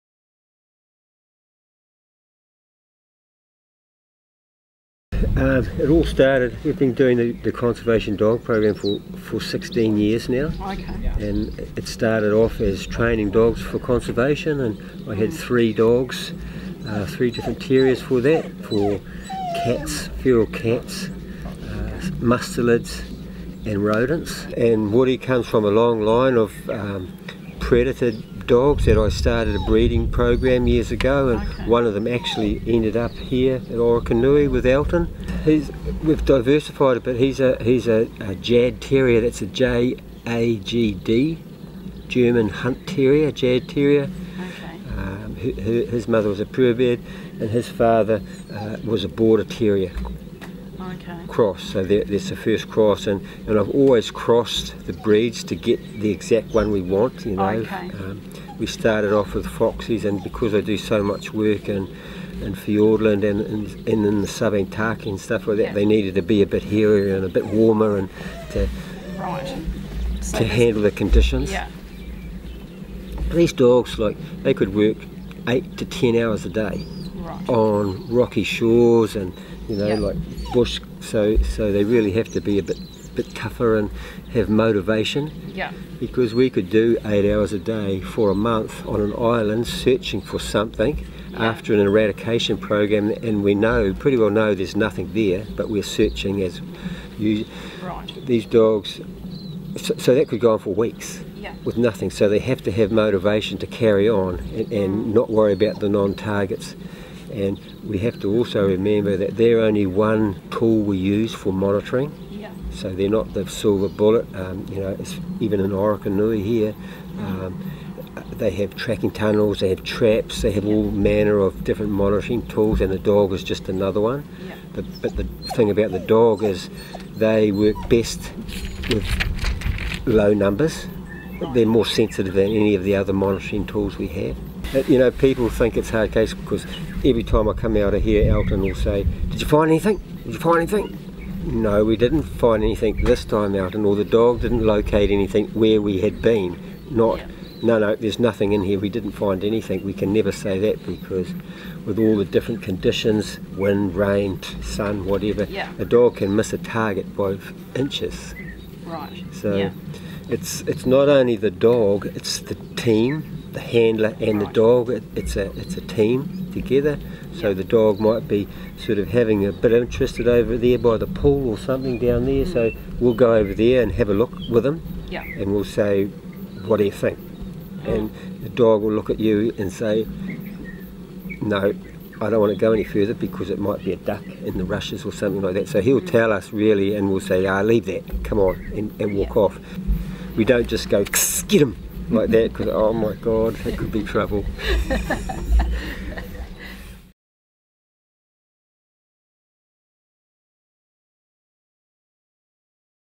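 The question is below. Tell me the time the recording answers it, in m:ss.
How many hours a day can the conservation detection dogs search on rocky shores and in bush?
1:15.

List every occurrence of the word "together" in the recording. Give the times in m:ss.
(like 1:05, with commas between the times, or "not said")
2:46.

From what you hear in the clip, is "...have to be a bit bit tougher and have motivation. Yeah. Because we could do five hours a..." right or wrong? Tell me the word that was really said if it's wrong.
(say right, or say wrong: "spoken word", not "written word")
wrong: "eight", not "five".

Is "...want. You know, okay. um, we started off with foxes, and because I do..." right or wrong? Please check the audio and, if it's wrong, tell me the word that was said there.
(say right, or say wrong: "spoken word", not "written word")
right.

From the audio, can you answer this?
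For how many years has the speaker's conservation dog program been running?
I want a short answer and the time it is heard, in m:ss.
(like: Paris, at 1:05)
16, at 0:09.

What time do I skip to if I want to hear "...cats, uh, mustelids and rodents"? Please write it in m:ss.
0:20.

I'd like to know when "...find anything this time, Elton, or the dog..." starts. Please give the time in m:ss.
2:22.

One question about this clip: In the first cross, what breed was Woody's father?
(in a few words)
Border Terrier.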